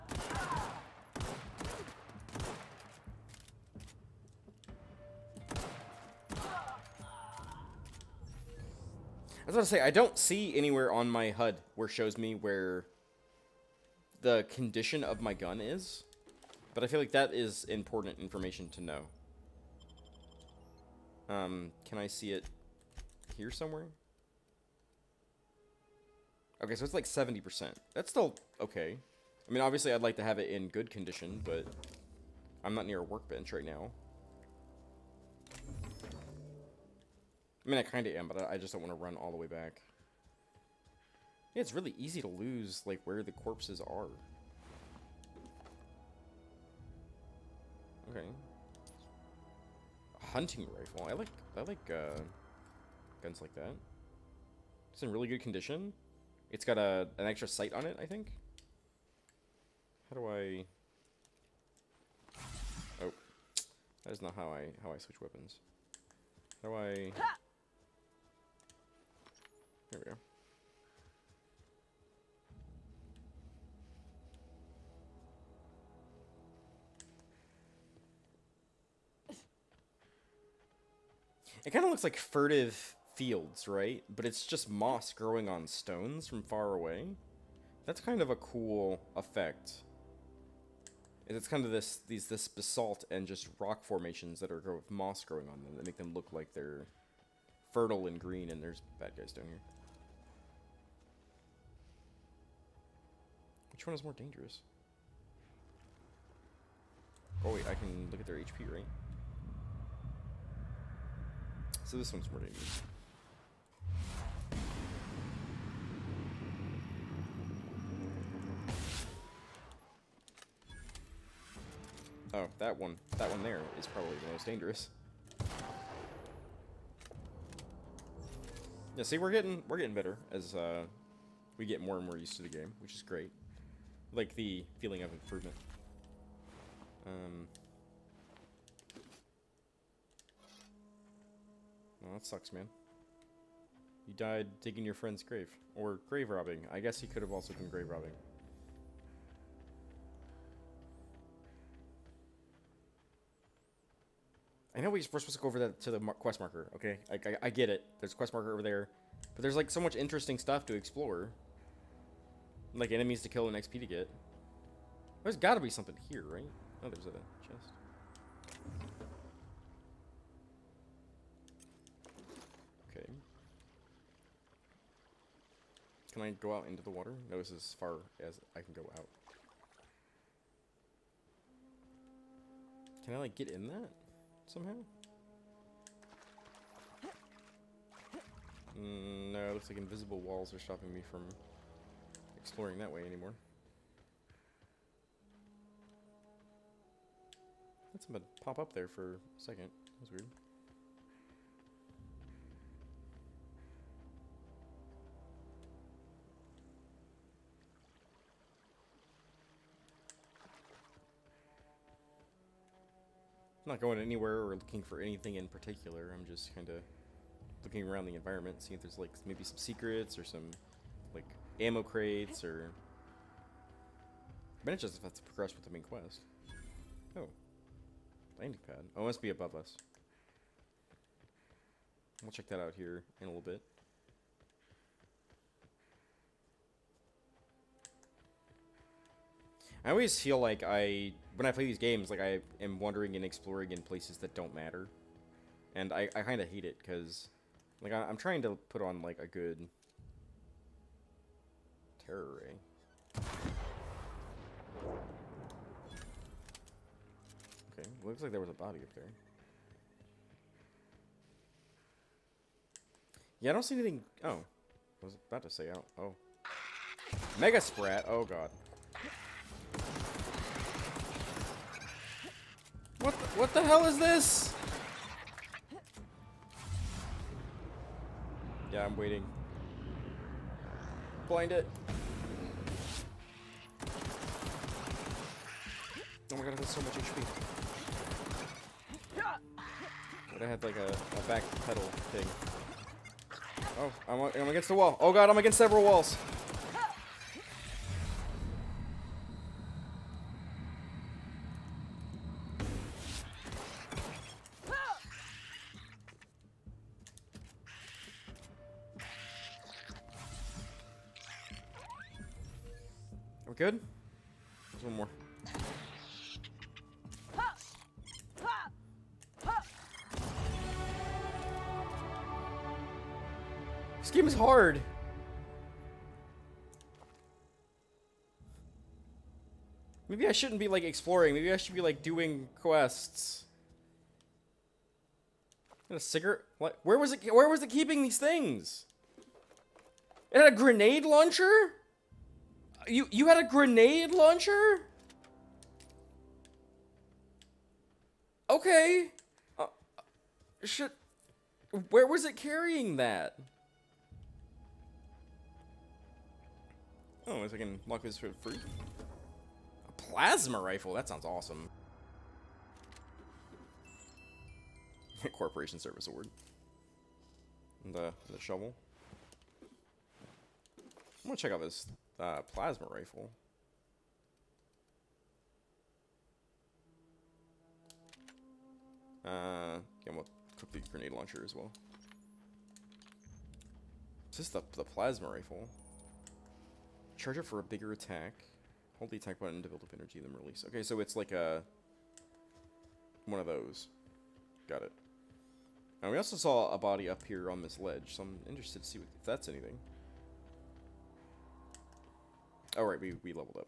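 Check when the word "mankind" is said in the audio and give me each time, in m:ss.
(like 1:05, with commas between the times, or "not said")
not said.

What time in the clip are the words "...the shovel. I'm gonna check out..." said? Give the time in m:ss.
6:08.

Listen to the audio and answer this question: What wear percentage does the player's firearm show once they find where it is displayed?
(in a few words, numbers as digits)
70%.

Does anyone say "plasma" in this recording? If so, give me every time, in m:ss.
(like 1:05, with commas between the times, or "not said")
6:00, 6:12, 6:24.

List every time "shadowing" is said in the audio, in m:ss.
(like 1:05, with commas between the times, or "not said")
not said.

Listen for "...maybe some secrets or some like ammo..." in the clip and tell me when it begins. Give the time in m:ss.
3:39.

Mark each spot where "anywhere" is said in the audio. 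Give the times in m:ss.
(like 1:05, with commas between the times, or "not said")
0:10, 3:33.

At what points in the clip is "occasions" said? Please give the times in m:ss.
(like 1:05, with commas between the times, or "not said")
not said.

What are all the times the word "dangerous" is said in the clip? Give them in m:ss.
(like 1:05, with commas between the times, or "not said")
1:44, 1:52, 2:04.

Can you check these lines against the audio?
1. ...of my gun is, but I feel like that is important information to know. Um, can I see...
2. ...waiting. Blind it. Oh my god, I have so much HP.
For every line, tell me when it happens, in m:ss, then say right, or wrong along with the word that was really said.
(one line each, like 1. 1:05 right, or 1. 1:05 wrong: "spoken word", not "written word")
1. 0:15 right
2. 4:38 right.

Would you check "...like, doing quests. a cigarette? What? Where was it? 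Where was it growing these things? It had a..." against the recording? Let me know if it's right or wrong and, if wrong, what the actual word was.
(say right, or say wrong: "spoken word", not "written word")
wrong: "keeping", not "growing".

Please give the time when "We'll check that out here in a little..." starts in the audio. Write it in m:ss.
3:52.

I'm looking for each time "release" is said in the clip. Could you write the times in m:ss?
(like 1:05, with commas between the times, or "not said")
6:30.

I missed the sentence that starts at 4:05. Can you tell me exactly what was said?
And I, I kind of hate it, because, like, I, am trying to put on, like, a good terror ray.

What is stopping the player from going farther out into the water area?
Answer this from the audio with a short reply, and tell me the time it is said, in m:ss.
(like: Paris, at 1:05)
Invisible walls, at 3:09.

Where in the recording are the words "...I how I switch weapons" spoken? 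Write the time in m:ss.
1:04.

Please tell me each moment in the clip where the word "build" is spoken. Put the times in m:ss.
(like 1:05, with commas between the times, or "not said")
6:29.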